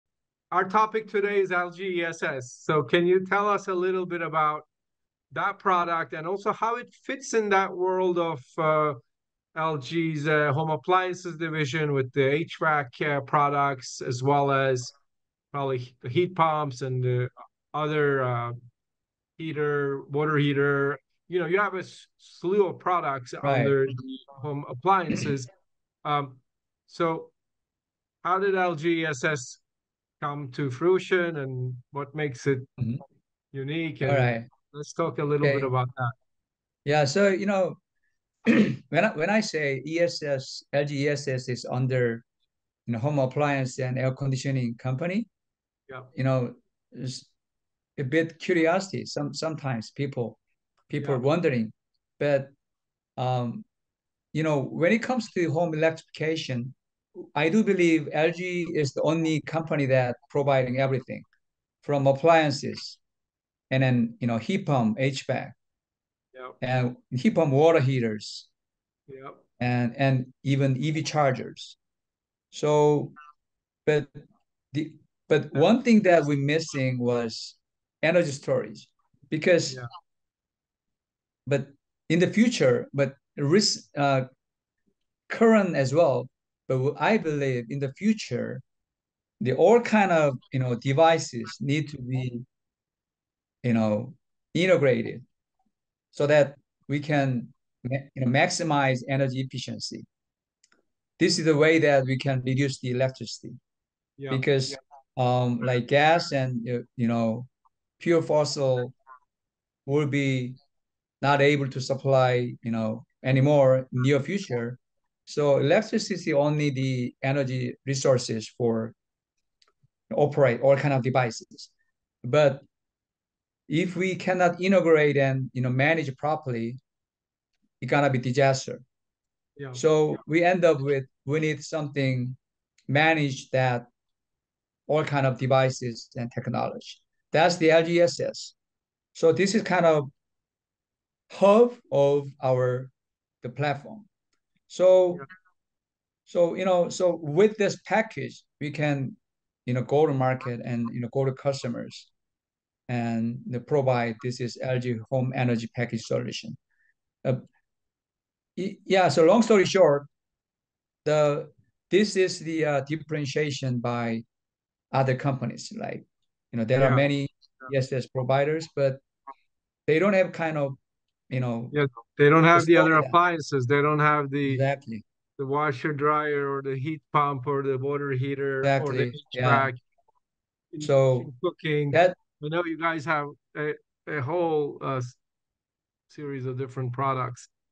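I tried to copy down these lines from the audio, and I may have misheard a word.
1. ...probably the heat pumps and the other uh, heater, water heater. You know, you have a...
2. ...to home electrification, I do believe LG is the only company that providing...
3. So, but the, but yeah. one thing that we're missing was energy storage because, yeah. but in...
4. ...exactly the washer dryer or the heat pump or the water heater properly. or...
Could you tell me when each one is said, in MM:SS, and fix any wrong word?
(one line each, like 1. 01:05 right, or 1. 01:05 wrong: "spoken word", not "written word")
1. 00:15 right
2. 00:55 right
3. 01:12 right
4. 02:54 wrong: "exactly", not "properly".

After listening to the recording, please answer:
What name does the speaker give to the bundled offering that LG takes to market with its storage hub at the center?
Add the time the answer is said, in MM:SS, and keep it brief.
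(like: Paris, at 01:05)
LG Home Energy Package, at 02:34.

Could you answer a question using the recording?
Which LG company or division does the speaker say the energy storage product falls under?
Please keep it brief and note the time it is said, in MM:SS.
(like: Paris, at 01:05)
Home appliance and air conditioning company, at 00:42.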